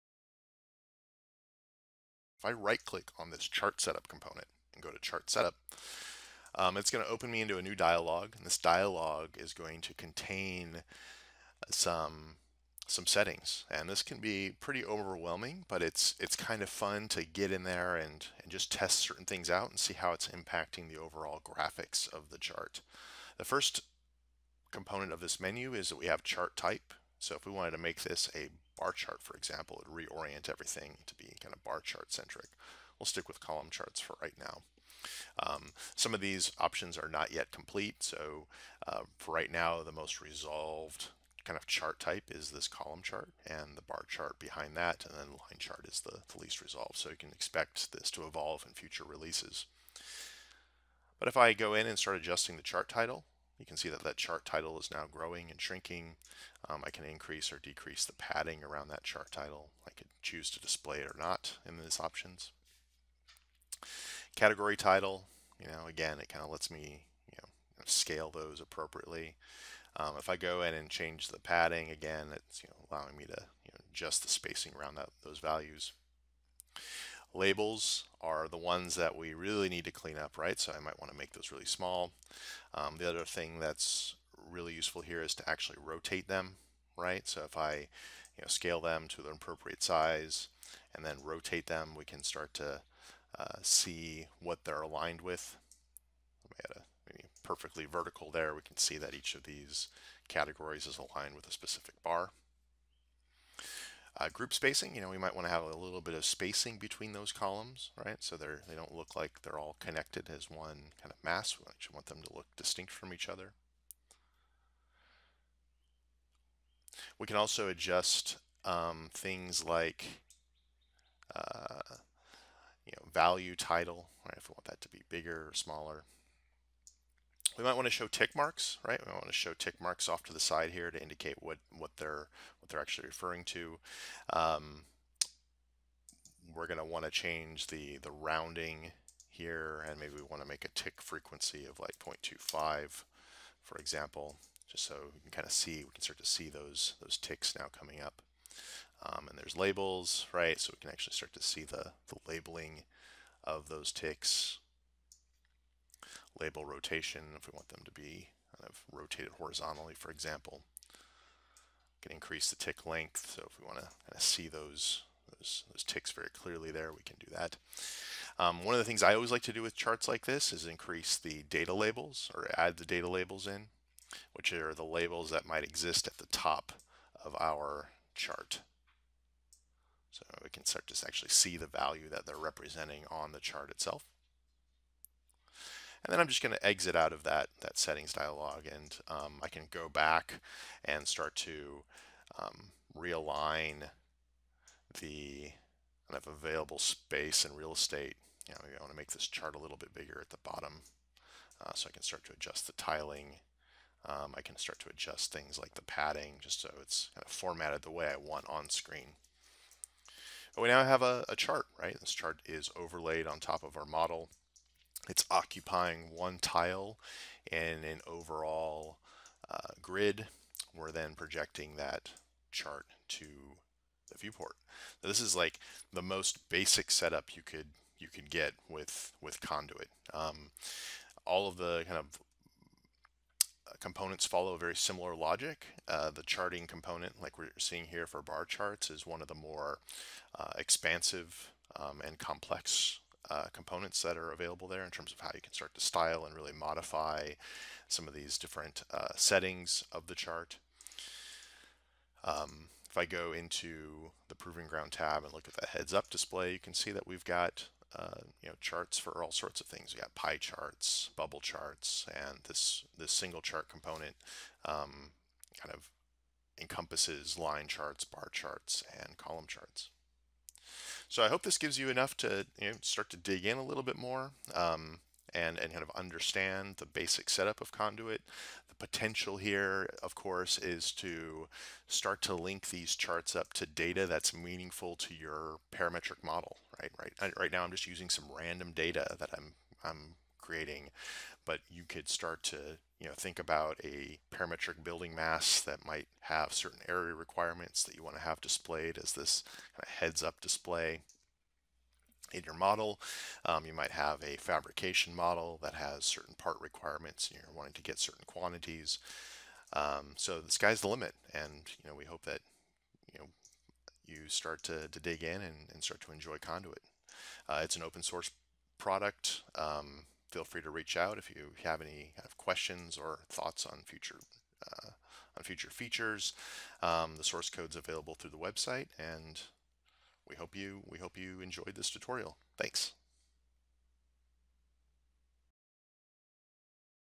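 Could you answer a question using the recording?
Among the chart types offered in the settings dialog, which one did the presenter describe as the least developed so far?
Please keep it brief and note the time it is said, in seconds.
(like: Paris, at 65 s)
Line chart, at 45 s.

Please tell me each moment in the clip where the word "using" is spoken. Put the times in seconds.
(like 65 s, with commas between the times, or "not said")
287 s.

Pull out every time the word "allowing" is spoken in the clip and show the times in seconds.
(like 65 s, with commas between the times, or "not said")
72 s.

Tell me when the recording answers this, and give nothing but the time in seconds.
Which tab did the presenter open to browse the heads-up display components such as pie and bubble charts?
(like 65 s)
254 s.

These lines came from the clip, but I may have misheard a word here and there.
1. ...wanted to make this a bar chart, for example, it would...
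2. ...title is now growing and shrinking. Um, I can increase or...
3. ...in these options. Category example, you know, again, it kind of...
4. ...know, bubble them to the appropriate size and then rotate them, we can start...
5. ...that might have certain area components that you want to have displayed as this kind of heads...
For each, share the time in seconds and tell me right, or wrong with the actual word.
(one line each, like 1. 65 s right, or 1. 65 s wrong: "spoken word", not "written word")
1. 27 s right
2. 54 s right
3. 61 s wrong: "title", not "example"
4. 88 s wrong: "scale", not "bubble"
5. 295 s wrong: "requirements", not "components".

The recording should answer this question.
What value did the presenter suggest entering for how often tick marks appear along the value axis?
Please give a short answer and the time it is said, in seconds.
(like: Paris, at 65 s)
0.25, at 141 s.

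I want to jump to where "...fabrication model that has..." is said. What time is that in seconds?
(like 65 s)
304 s.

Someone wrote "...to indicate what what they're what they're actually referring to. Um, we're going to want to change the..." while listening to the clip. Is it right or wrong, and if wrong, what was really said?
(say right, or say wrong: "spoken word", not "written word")
right.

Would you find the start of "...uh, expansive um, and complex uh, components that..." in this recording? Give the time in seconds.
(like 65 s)
240 s.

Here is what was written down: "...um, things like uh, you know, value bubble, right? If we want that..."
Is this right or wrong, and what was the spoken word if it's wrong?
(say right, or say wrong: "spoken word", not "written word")
wrong: "title", not "bubble".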